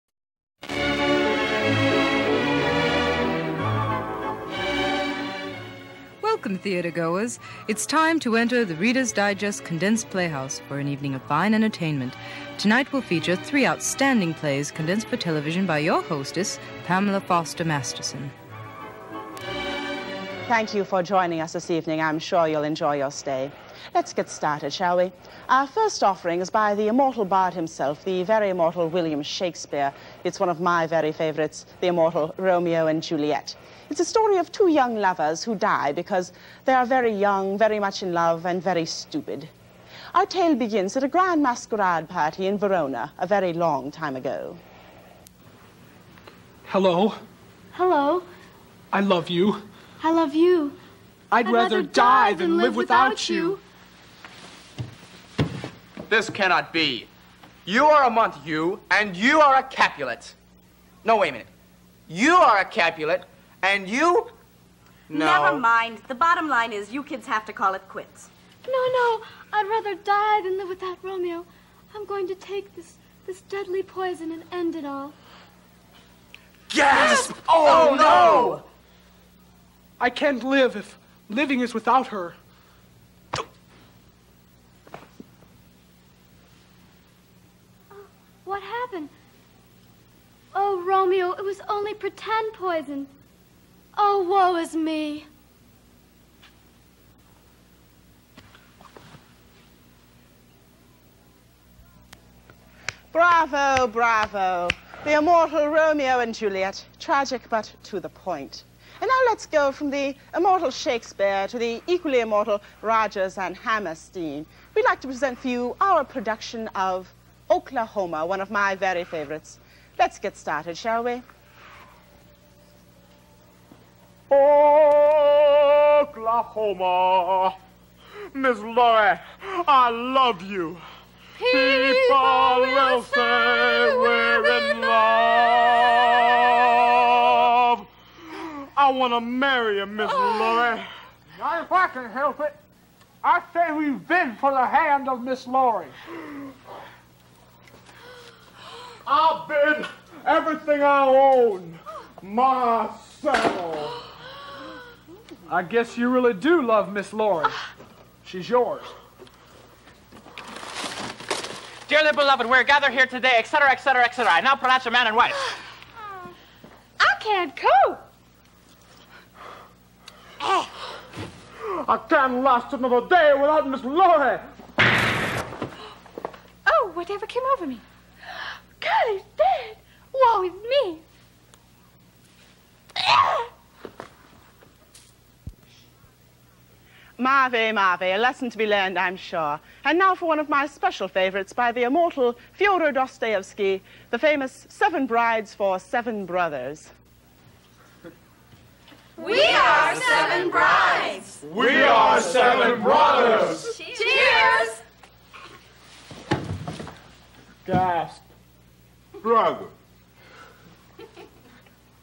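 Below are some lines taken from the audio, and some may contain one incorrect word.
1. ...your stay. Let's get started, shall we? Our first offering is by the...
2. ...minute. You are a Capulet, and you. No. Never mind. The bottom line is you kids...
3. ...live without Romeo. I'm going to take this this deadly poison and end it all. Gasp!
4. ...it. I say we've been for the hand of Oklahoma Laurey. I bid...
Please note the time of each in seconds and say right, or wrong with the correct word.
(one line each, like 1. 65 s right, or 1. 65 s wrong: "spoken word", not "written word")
1. 22 s right
2. 61 s right
3. 70 s right
4. 142 s wrong: "Miss", not "Oklahoma".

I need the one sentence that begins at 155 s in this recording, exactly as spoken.
I guess you really do love Miss Laurey.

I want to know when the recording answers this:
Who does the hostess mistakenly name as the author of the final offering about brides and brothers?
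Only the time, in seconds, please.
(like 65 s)
192 s.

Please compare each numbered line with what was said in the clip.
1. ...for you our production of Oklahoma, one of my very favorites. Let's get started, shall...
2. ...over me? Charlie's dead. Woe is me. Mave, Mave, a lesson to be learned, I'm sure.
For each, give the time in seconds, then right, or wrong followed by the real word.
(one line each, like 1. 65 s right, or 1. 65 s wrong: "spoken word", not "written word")
1. 115 s right
2. 177 s right.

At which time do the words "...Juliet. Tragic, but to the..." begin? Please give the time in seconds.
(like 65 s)
106 s.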